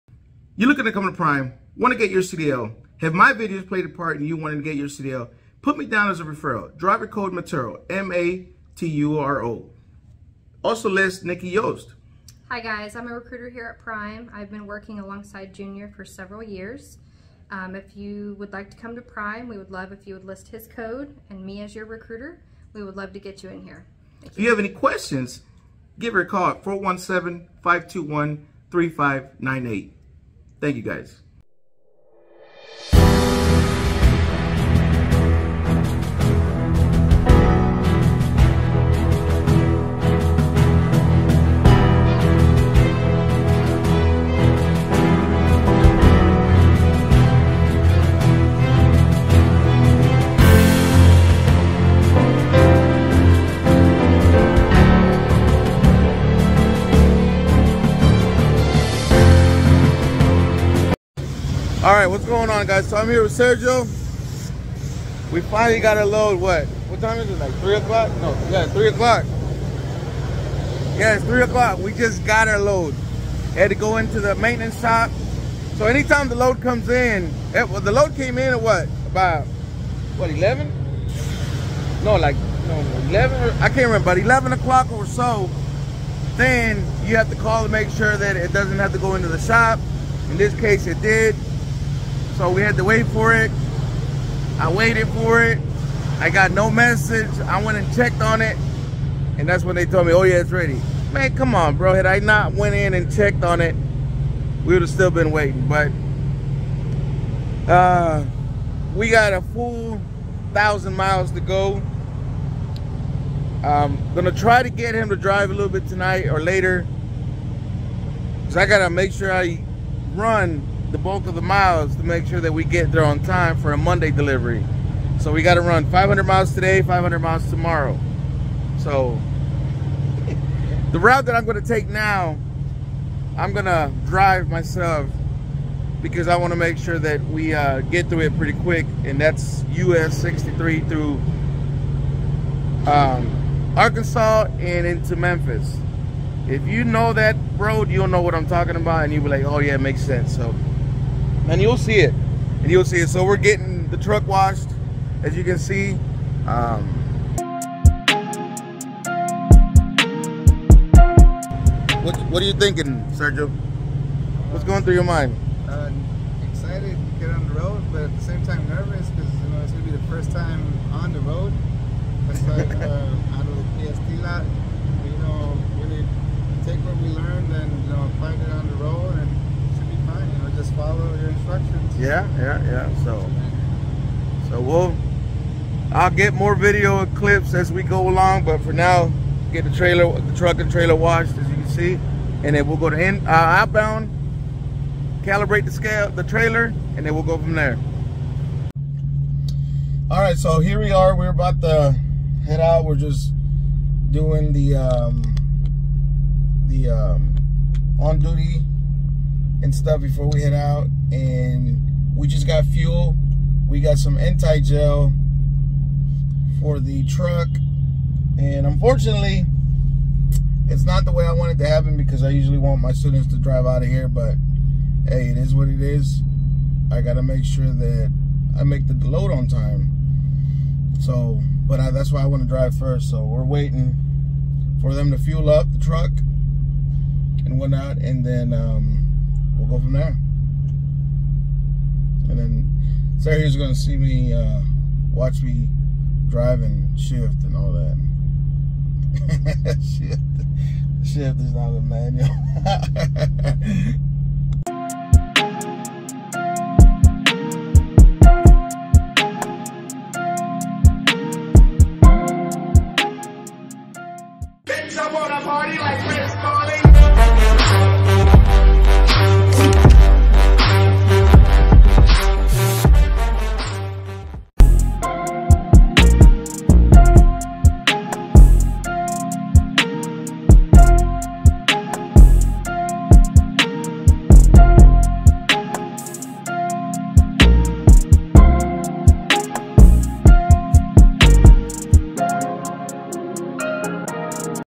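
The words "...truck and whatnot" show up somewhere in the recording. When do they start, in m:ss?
3:55.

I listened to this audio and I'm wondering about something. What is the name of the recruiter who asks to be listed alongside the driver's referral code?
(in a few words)
Nikki Yost.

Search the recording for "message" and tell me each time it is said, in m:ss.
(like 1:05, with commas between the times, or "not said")
1:36.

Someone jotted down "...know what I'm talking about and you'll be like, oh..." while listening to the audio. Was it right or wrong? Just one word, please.
right.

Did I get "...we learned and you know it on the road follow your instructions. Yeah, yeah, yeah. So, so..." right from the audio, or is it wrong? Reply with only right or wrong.
right.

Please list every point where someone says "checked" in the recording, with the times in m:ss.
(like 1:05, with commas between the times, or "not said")
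1:37, 1:43.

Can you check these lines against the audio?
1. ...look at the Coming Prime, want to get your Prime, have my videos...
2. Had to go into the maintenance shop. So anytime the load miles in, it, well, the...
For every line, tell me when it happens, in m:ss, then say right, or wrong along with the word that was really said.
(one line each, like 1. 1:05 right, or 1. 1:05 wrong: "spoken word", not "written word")
1. 0:00 wrong: "CDL", not "Prime"
2. 1:13 wrong: "comes", not "miles".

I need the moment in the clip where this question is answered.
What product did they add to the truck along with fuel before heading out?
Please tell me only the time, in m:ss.
3:34.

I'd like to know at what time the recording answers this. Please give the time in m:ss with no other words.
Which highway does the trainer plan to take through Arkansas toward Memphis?
2:19.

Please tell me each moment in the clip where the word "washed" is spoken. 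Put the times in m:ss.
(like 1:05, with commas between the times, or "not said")
2:34, 3:10.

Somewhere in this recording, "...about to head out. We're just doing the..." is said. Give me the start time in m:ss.
3:21.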